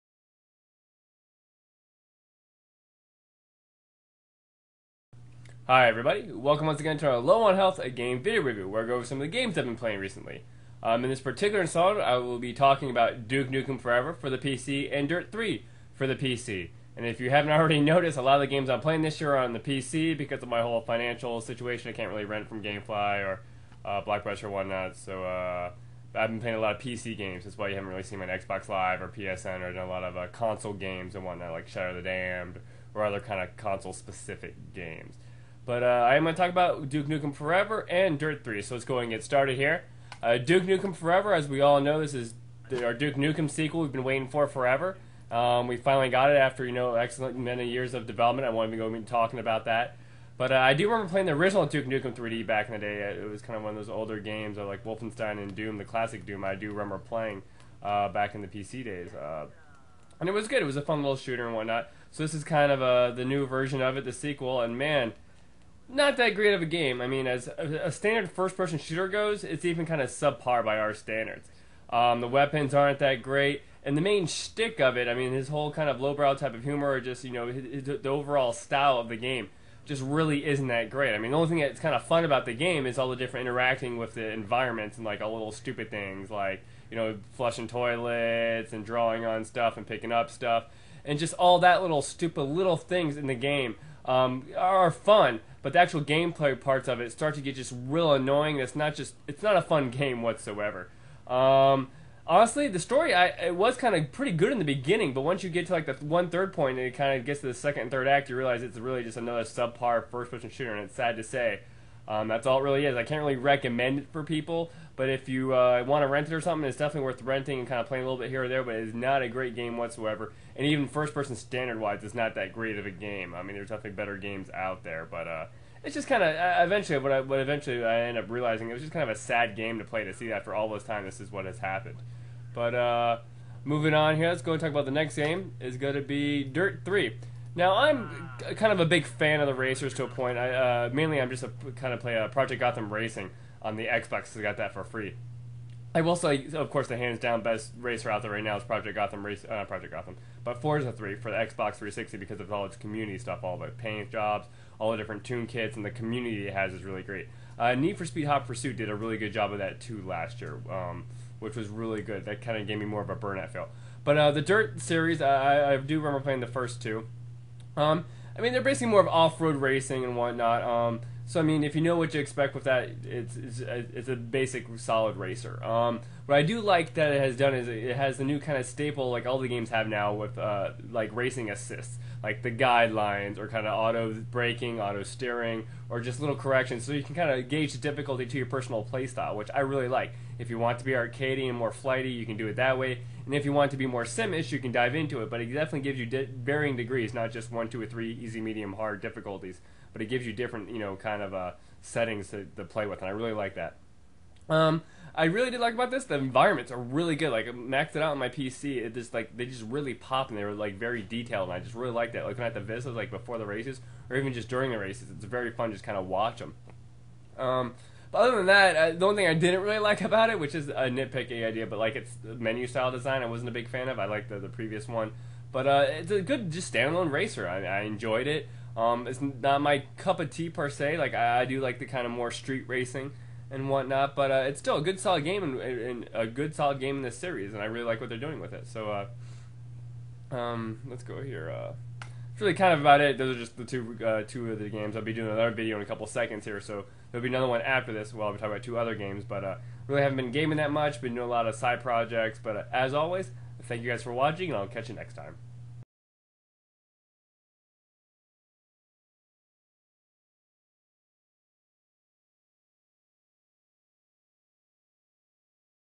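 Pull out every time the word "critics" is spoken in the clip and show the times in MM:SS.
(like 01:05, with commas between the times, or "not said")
not said.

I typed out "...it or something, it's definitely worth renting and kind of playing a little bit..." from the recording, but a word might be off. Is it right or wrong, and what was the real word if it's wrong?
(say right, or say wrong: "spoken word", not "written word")
right.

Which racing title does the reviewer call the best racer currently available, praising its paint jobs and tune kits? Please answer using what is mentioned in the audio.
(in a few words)
Forza 3.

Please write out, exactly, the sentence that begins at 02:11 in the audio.
This is what has happened, but uh, moving on here, let's go and talk about the next game.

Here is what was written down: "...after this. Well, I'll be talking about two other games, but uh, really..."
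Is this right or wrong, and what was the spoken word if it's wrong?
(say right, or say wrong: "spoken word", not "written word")
right.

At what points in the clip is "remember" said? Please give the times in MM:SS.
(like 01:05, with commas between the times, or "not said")
00:50, 00:56, 02:45.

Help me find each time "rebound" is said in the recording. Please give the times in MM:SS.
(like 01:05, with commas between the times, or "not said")
not said.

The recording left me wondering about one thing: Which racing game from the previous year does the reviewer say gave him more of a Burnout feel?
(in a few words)
Need for Speed Hot Pursuit.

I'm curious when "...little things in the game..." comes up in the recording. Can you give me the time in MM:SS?
01:32.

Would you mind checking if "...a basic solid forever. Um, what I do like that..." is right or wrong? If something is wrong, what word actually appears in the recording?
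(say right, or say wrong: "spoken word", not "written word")
wrong: "racer", not "forever".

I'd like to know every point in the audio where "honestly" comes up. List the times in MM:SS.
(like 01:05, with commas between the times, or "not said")
01:42.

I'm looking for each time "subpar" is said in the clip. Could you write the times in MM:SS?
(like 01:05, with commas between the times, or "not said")
01:10, 01:49.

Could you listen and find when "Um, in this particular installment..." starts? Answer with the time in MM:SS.
00:10.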